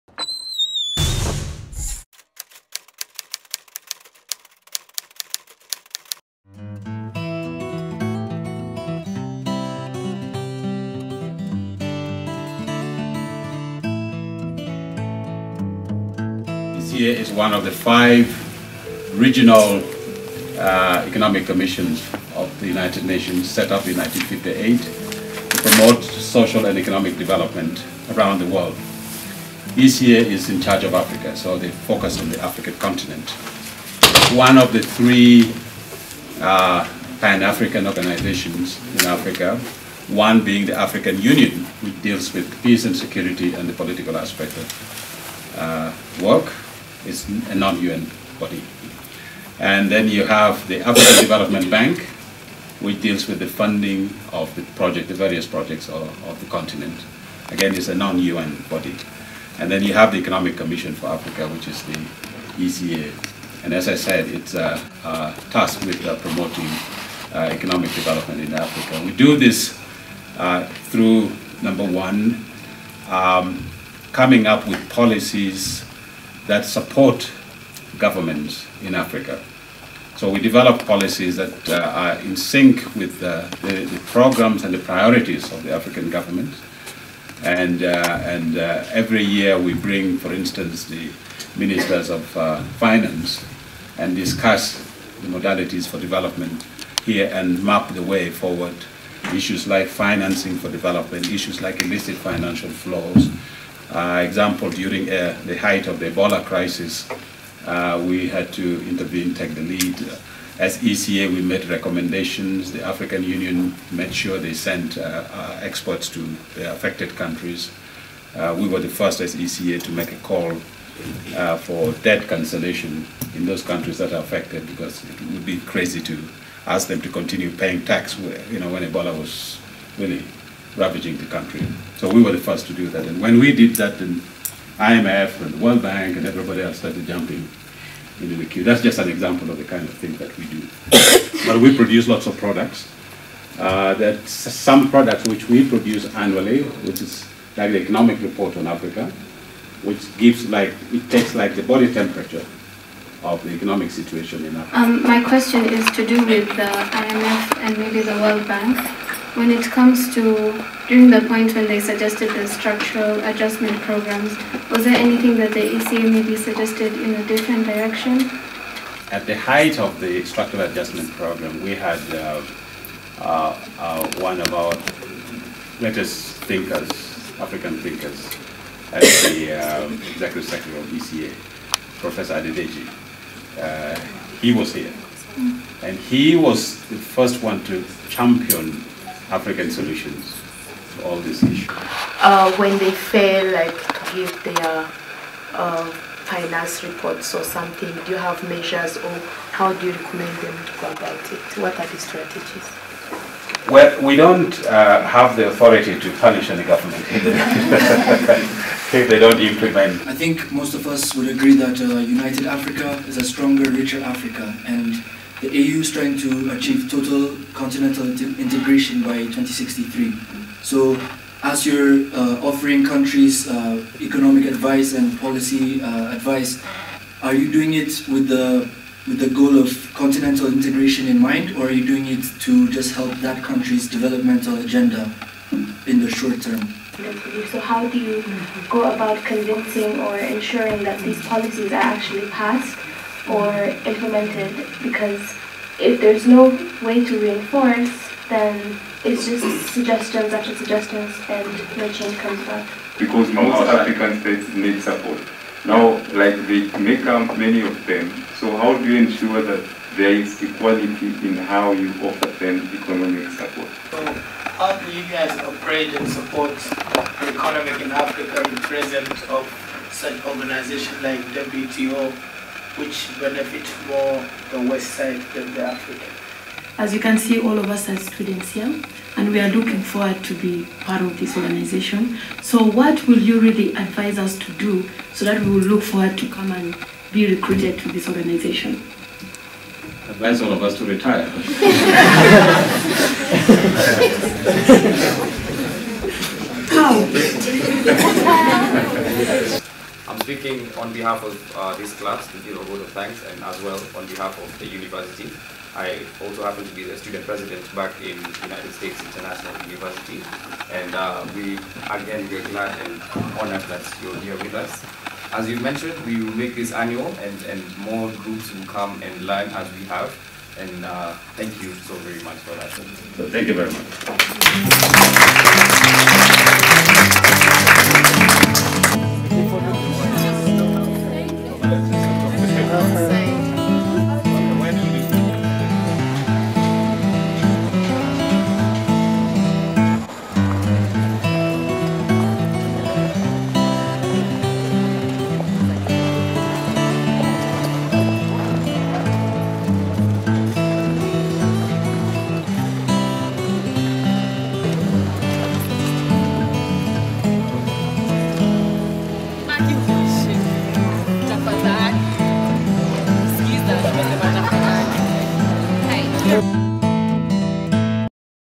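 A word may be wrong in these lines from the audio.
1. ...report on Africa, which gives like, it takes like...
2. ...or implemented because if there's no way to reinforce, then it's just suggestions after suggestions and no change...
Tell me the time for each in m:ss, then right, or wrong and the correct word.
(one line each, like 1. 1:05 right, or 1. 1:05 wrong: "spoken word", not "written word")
1. 2:28 right
2. 4:03 right.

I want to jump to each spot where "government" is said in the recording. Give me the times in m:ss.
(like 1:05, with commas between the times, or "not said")
1:17, 1:26, 3:26.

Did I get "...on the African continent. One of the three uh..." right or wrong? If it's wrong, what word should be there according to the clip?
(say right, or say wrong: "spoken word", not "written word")
right.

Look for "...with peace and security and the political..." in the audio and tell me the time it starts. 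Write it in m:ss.
0:42.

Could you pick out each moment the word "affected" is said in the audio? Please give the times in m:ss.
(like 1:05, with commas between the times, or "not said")
1:56, 2:04.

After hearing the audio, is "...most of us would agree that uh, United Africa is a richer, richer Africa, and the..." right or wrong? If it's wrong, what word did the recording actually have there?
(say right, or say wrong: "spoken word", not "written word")
wrong: "stronger", not "richer".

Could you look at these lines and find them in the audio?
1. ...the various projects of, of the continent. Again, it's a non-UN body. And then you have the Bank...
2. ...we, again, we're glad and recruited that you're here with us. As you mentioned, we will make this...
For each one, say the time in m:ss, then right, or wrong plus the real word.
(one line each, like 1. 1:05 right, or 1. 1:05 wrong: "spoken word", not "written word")
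1. 0:55 wrong: "Economic", not "Bank"
2. 5:11 wrong: "honored", not "recruited".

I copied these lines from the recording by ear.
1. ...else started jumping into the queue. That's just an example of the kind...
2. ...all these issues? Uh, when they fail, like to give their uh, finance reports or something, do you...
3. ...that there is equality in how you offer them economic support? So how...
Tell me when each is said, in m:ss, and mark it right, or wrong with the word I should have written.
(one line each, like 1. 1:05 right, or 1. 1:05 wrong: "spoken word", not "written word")
1. 2:16 right
2. 3:11 right
3. 4:19 right.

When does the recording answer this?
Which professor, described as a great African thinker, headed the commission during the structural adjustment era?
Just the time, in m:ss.
3:01.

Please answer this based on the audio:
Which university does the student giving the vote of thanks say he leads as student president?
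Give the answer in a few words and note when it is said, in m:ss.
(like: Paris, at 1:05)
United States International University, at 5:08.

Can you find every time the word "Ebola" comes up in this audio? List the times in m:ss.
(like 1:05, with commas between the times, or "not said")
1:46, 2:08.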